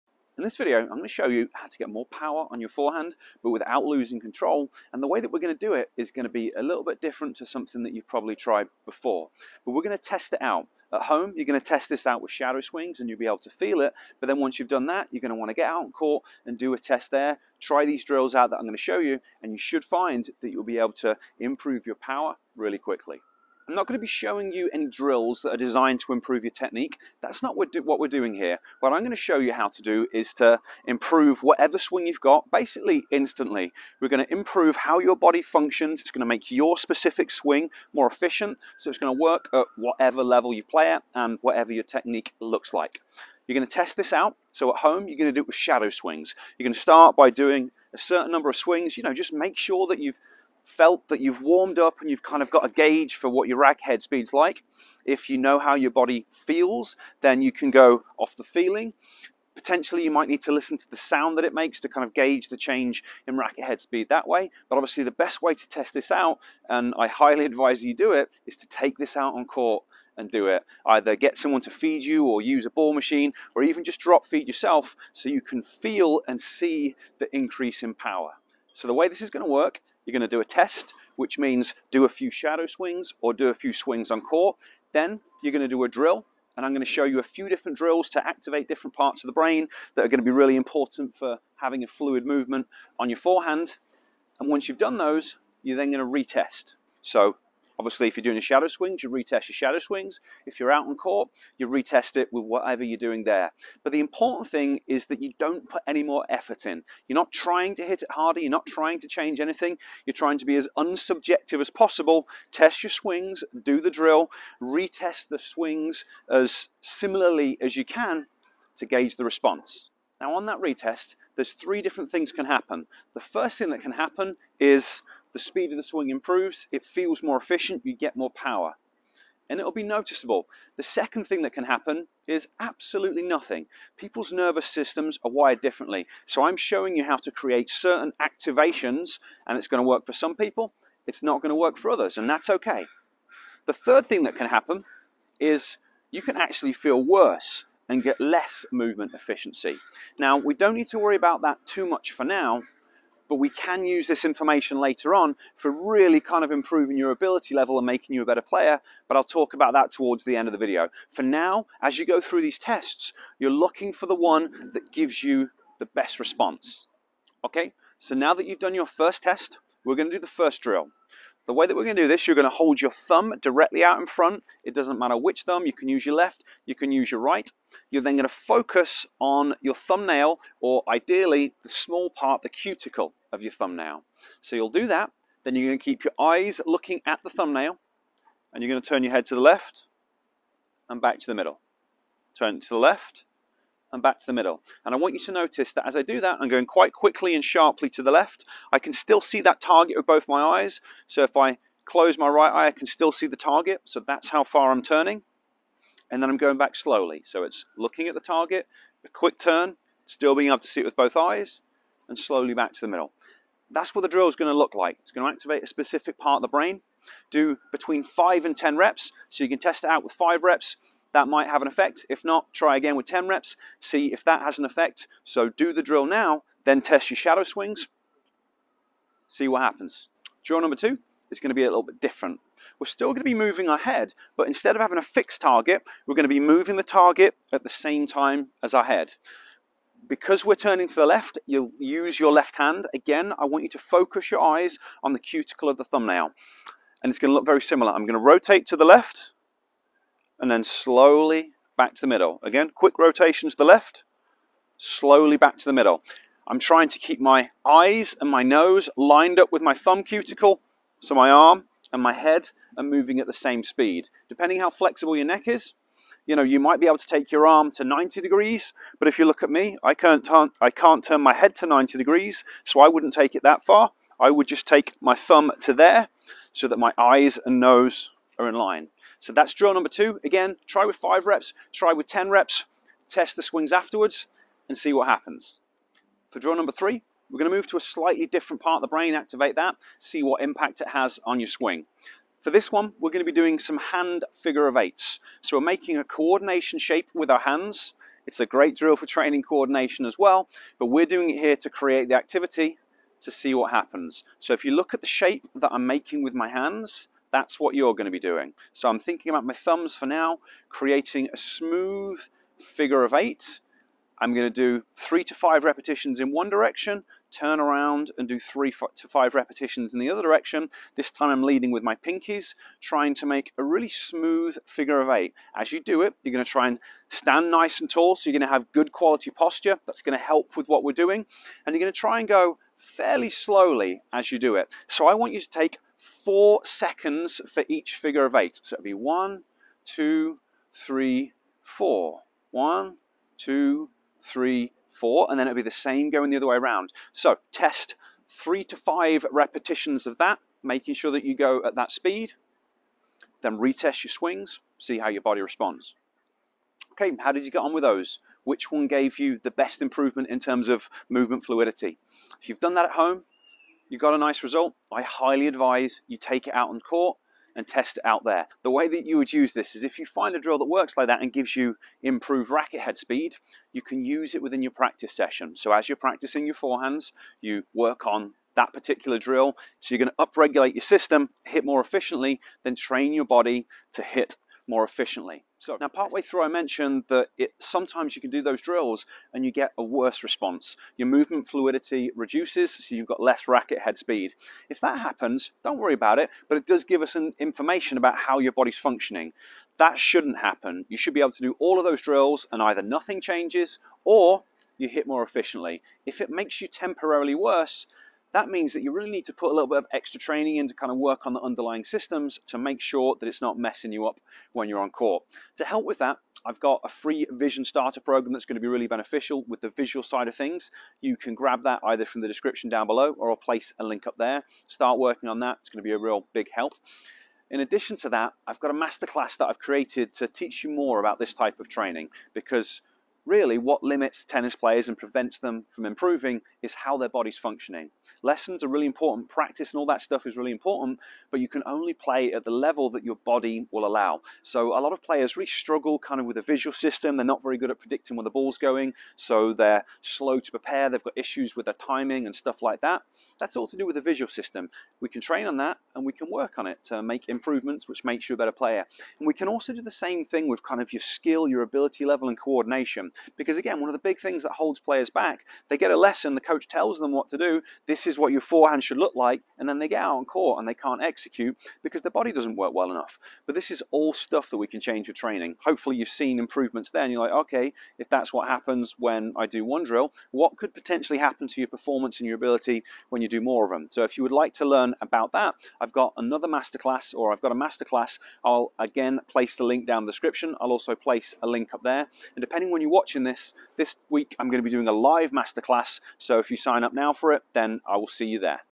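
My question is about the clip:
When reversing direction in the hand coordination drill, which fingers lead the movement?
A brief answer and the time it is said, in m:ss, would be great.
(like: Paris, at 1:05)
pinkies, at 5:21.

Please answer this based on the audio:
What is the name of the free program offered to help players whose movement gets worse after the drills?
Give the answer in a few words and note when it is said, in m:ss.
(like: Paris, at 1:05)
vision starter program, at 6:56.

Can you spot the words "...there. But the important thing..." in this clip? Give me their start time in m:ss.
1:43.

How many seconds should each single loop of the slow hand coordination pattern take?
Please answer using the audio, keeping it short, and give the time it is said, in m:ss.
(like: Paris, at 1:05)
4, at 5:36.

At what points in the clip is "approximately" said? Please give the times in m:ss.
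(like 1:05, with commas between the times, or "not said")
not said.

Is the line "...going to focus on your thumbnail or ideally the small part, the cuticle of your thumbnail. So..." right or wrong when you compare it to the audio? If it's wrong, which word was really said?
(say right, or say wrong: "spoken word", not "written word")
right.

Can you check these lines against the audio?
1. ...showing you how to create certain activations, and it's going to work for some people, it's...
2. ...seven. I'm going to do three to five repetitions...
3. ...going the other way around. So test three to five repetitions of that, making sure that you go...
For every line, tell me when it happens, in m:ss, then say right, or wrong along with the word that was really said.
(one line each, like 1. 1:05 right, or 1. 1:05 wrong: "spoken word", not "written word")
1. 2:16 right
2. 5:13 wrong: "eight", not "seven"
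3. 5:46 right.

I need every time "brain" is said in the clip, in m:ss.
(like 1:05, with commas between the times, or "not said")
1:29, 3:36, 4:48.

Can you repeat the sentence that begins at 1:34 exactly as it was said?
And once you've done those, you're then going to retest.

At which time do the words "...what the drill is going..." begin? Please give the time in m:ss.
3:33.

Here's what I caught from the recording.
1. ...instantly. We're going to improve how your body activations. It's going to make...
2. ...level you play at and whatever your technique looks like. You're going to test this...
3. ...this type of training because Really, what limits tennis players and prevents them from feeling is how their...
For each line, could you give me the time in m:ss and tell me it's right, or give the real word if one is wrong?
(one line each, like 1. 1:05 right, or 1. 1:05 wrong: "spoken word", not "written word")
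1. 0:33 wrong: "functions", not "activations"
2. 0:40 right
3. 7:11 wrong: "improving", not "feeling".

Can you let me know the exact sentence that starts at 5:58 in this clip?
Which one gave you the best improvement in terms of movement fluidity?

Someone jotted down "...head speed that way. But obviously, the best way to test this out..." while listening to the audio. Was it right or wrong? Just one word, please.
right.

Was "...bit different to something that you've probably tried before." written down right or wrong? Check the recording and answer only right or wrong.
right.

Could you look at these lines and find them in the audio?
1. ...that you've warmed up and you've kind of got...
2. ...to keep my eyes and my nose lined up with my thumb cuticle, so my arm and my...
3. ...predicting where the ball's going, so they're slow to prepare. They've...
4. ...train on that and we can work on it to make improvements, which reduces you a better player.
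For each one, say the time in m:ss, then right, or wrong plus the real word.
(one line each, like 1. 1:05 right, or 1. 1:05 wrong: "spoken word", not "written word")
1. 0:51 right
2. 4:16 right
3. 7:27 right
4. 7:35 wrong: "makes", not "reduces".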